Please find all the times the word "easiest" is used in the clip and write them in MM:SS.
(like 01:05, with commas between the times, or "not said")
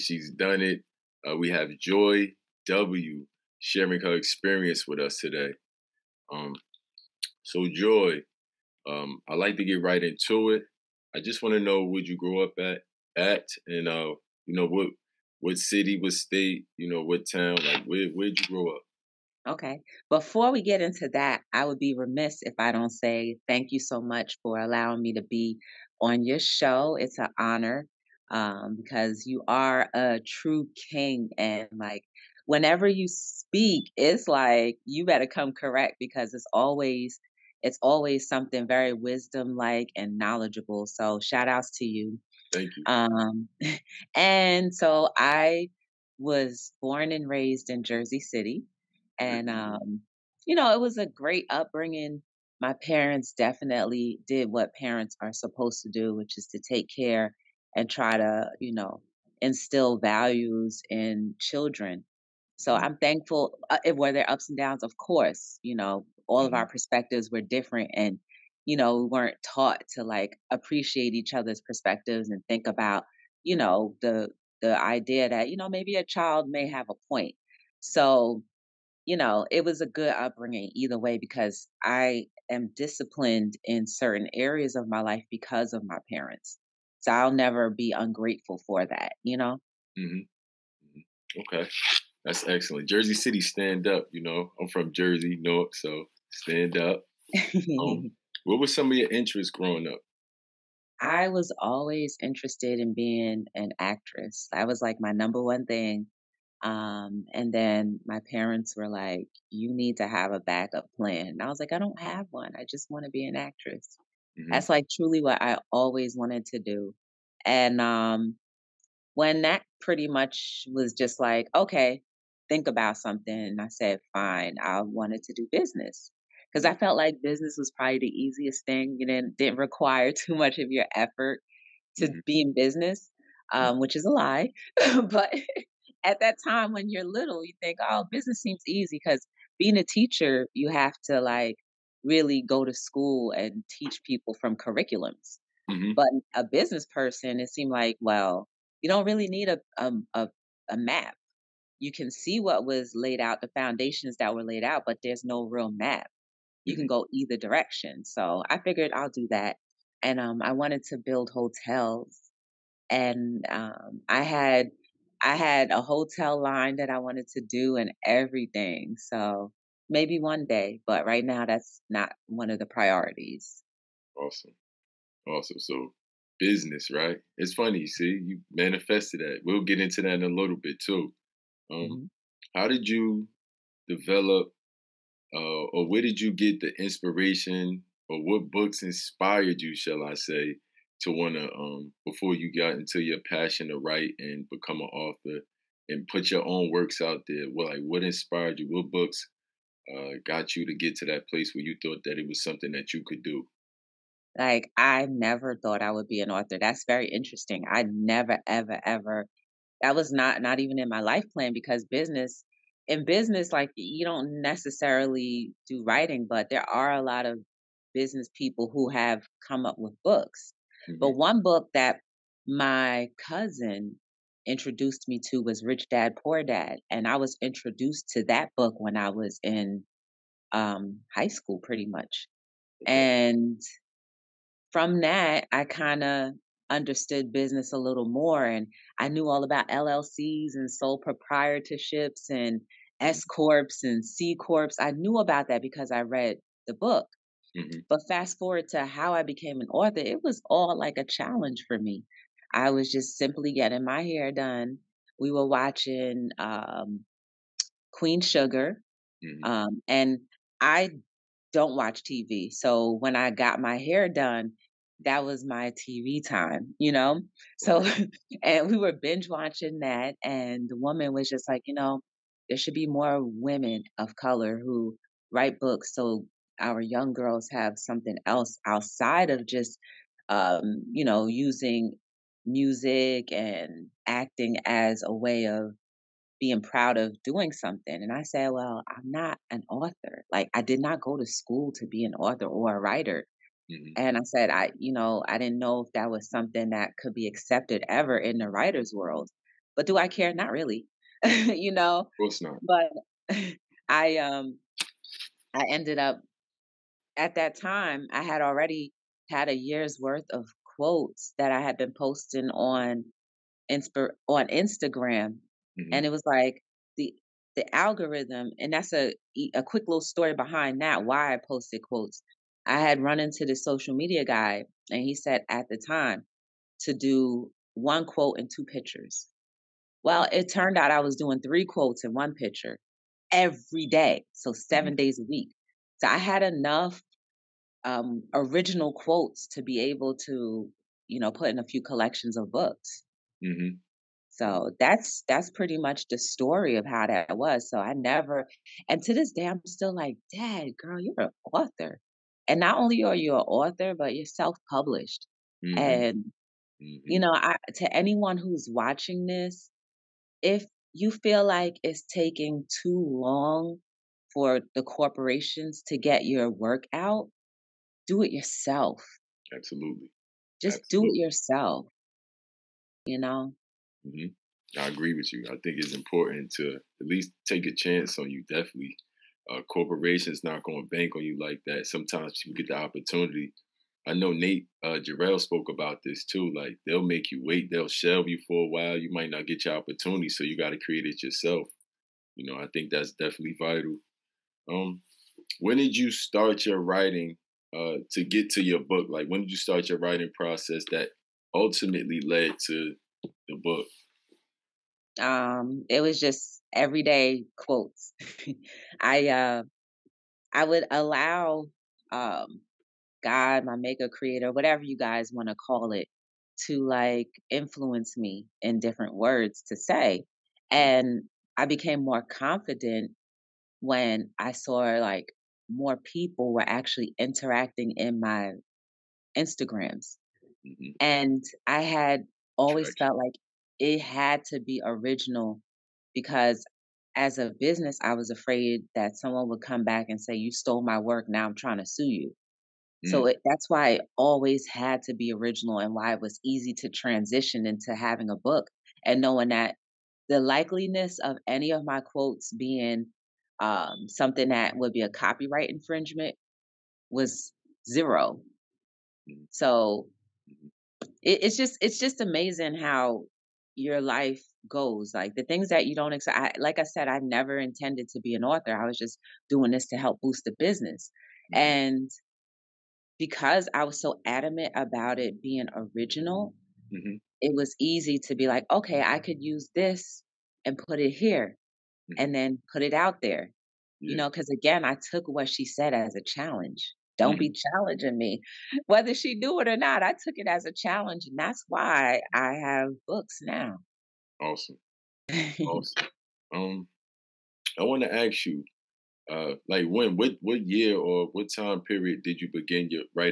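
02:08.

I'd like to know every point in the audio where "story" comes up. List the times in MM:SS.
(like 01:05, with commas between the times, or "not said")
05:20, 05:46.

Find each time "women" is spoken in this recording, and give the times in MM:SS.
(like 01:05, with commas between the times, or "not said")
04:33.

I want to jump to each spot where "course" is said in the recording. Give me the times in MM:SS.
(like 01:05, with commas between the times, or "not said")
01:04, 05:02.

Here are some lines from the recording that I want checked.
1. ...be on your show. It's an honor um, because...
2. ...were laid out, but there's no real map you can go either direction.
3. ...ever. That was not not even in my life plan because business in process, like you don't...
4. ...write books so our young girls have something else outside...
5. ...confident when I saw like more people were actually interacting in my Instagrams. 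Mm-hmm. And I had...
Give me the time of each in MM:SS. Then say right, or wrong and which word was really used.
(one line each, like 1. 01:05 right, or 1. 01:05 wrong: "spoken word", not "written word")
1. 00:25 right
2. 02:34 right
3. 03:28 wrong: "business", not "process"
4. 04:35 right
5. 07:02 right.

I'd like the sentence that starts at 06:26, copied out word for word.
Like they'll make you wait, they'll shelve you for a while.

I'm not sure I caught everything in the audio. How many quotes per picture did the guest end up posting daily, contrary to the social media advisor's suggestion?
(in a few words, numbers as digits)
3.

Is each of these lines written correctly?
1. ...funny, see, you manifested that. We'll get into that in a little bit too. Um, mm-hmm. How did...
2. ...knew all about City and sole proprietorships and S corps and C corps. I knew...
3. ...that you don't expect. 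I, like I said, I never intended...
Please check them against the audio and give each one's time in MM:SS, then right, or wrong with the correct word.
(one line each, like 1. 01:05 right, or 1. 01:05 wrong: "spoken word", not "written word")
1. 02:57 right
2. 03:59 wrong: "LLCs", not "City"
3. 07:45 right.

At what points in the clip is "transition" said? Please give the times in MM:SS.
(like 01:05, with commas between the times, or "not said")
07:26.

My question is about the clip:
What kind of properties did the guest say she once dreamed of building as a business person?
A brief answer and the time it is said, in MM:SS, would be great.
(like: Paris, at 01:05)
Hotels, at 02:41.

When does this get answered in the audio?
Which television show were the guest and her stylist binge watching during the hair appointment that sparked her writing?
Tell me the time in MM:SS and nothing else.
04:17.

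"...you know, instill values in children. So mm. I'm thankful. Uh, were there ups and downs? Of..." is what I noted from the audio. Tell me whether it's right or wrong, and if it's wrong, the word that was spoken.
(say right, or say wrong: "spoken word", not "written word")
right.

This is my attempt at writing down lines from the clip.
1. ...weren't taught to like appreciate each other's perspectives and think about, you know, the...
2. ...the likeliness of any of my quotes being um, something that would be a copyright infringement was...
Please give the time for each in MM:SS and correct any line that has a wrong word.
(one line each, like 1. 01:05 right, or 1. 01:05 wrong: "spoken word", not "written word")
1. 01:09 right
2. 07:30 right.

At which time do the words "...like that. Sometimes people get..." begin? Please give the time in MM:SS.
06:21.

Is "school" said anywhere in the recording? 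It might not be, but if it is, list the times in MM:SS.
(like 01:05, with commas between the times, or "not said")
02:22, 03:51, 04:51.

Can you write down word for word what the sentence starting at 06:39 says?
Like when did you start your writing process that ultimately led to the book?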